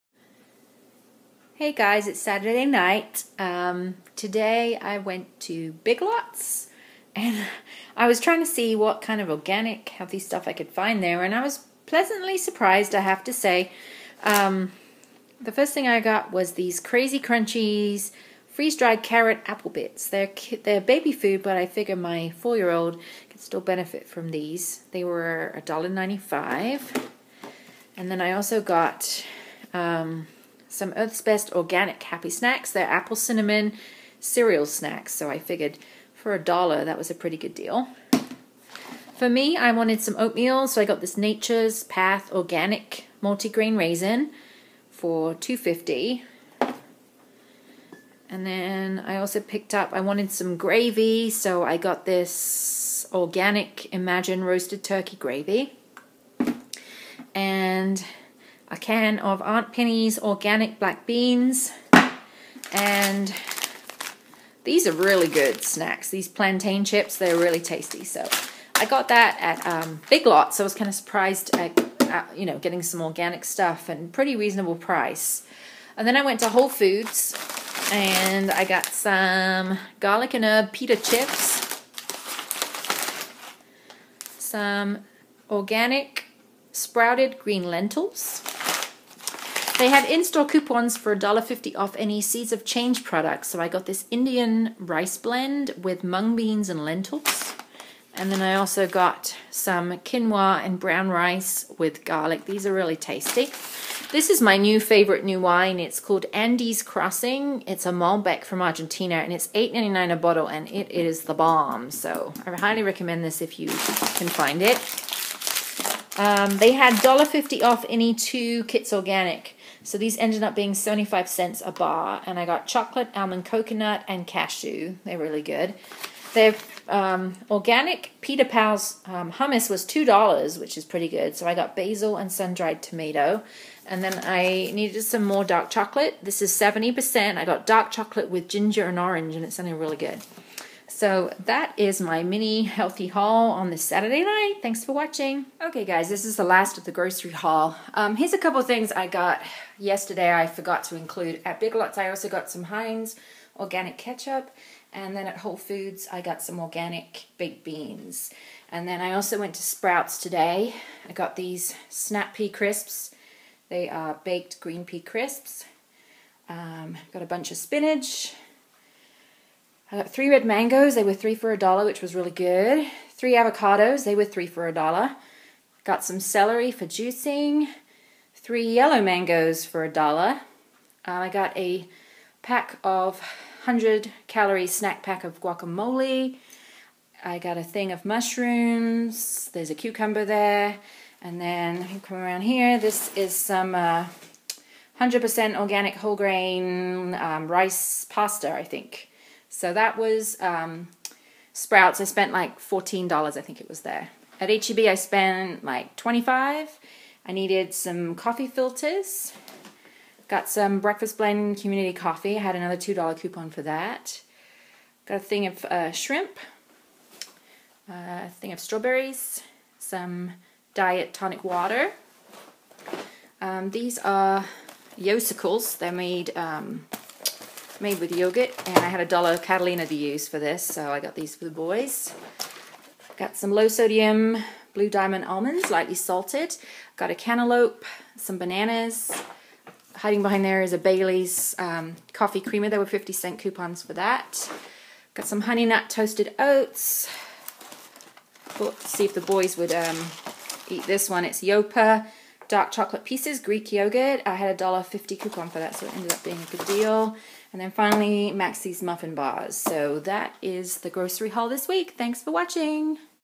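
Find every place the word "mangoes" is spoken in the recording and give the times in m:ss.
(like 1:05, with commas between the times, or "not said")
2:50, 2:59.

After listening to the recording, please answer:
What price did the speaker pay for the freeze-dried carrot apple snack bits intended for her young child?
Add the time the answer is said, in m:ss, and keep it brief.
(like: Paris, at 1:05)
$1.95, at 0:25.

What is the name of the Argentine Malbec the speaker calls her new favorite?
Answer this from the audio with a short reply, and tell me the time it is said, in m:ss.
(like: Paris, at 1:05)
Andes Crossing, at 1:46.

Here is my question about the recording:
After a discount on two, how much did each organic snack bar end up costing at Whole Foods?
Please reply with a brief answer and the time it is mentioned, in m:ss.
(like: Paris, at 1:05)
75 cents, at 2:00.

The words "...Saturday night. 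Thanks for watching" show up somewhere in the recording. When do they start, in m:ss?
2:23.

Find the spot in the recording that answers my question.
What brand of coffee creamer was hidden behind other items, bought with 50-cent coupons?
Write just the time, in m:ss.
4:00.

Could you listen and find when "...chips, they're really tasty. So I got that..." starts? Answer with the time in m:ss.
1:06.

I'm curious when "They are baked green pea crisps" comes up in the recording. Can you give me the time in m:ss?
2:43.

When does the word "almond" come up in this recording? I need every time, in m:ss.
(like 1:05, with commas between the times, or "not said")
2:03, 3:55.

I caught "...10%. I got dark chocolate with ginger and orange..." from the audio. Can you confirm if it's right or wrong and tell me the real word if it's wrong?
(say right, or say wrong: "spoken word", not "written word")
wrong: "70", not "10".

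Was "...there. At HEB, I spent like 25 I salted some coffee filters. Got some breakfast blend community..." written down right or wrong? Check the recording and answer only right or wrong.
wrong.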